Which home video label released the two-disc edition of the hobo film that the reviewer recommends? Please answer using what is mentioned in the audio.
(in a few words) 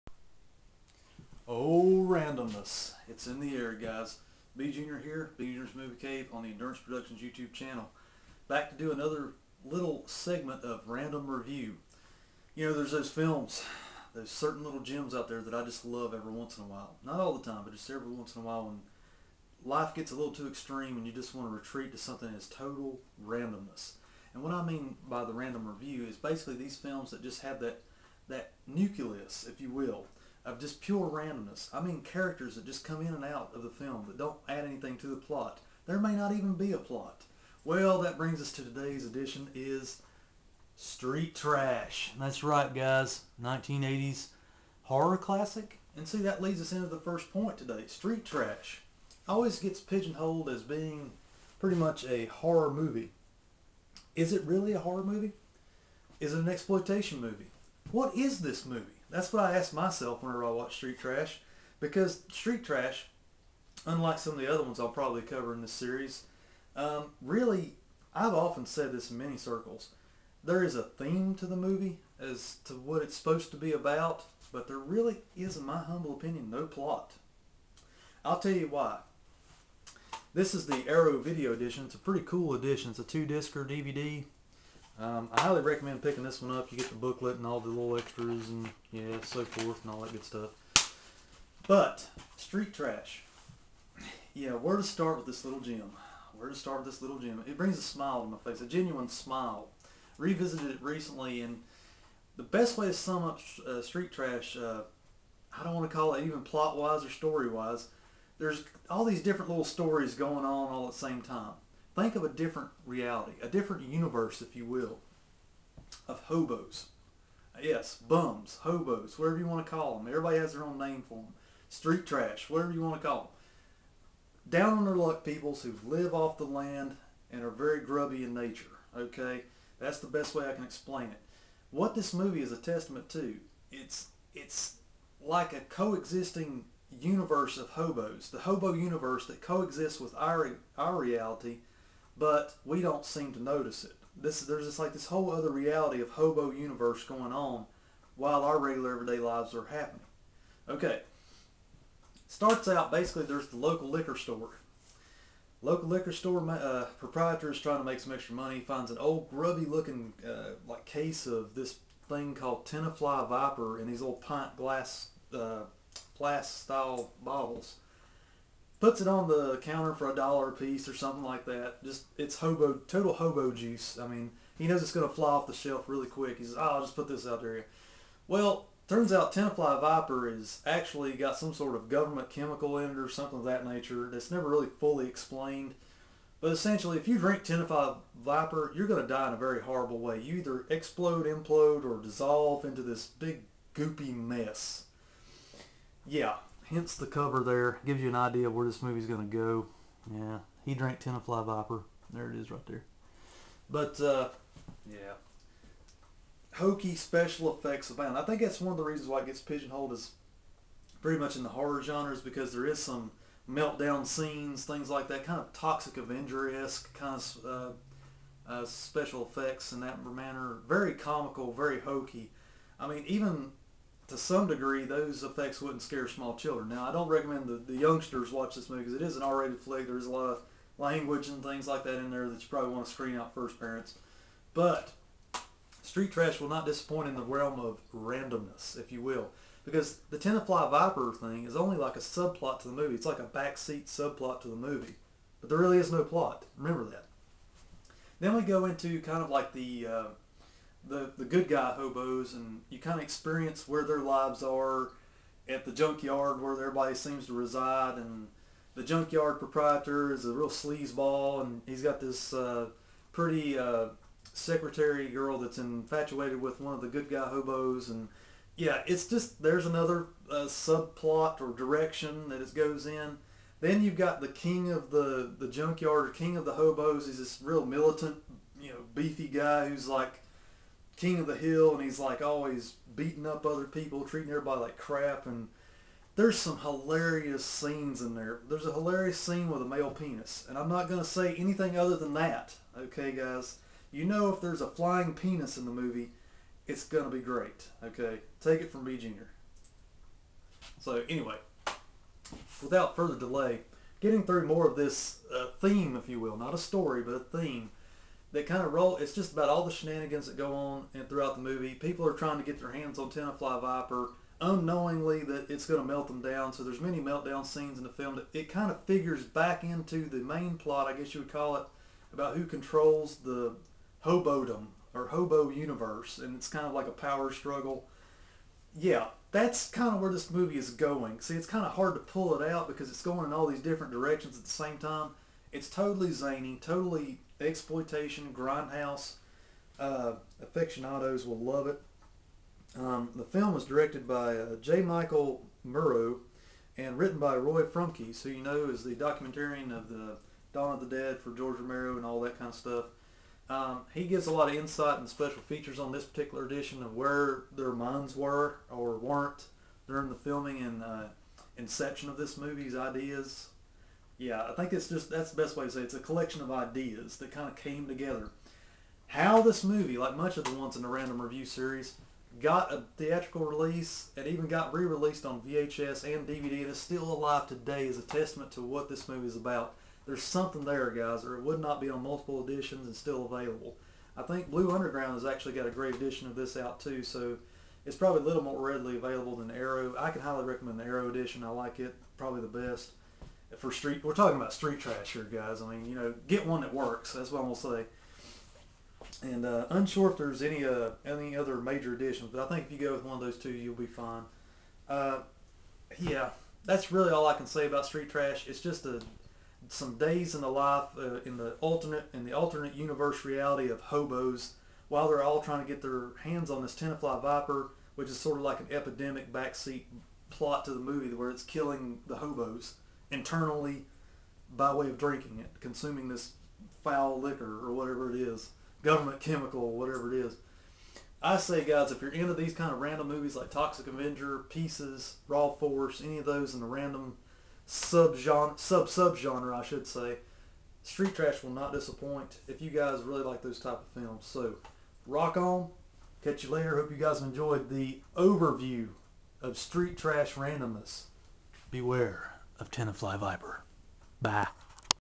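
Arrow Video.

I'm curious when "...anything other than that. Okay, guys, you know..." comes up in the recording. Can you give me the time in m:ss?
4:51.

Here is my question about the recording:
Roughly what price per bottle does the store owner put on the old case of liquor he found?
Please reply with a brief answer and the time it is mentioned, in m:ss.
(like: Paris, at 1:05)
$1, at 2:50.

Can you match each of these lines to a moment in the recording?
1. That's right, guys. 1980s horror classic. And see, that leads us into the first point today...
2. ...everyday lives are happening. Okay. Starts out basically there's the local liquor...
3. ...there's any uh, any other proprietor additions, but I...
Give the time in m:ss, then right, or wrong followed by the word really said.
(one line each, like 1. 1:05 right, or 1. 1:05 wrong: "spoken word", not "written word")
1. 0:42 right
2. 2:28 right
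3. 6:40 wrong: "major", not "proprietor".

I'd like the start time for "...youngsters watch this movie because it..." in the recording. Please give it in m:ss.
3:47.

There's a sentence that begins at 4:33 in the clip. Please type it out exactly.
Then you've got the king of the the junkyard or king of the hobos.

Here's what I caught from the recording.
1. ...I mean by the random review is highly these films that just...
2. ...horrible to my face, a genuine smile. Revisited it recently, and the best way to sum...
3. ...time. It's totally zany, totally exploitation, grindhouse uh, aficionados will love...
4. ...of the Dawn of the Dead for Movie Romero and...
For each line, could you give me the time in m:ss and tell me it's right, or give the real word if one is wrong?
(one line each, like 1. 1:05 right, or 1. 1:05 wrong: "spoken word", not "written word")
1. 0:24 wrong: "basically", not "highly"
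2. 1:37 wrong: "smile", not "horrible"
3. 5:34 right
4. 5:49 wrong: "George", not "Movie".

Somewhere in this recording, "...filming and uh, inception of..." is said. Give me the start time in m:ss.
6:00.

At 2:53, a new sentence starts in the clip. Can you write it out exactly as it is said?
I mean, he knows it's going to fly off the shelf really quick.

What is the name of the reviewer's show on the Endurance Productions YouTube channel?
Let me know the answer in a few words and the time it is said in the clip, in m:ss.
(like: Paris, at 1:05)
B Junior's Movie Cave, at 0:05.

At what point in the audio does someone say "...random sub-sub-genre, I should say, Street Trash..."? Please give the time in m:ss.
7:16.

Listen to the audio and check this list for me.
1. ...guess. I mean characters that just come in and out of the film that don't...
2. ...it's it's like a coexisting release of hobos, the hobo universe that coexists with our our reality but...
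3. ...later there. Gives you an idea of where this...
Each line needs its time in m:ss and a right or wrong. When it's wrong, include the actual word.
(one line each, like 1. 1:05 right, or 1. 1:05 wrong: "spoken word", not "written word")
1. 0:31 wrong: "randomness", not "guess"
2. 2:13 wrong: "universe", not "release"
3. 3:17 wrong: "cover", not "later".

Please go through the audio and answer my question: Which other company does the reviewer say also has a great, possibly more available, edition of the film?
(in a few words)
Blue Underground.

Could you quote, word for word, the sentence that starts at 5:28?
Yeah, that's kind of where this movie is going.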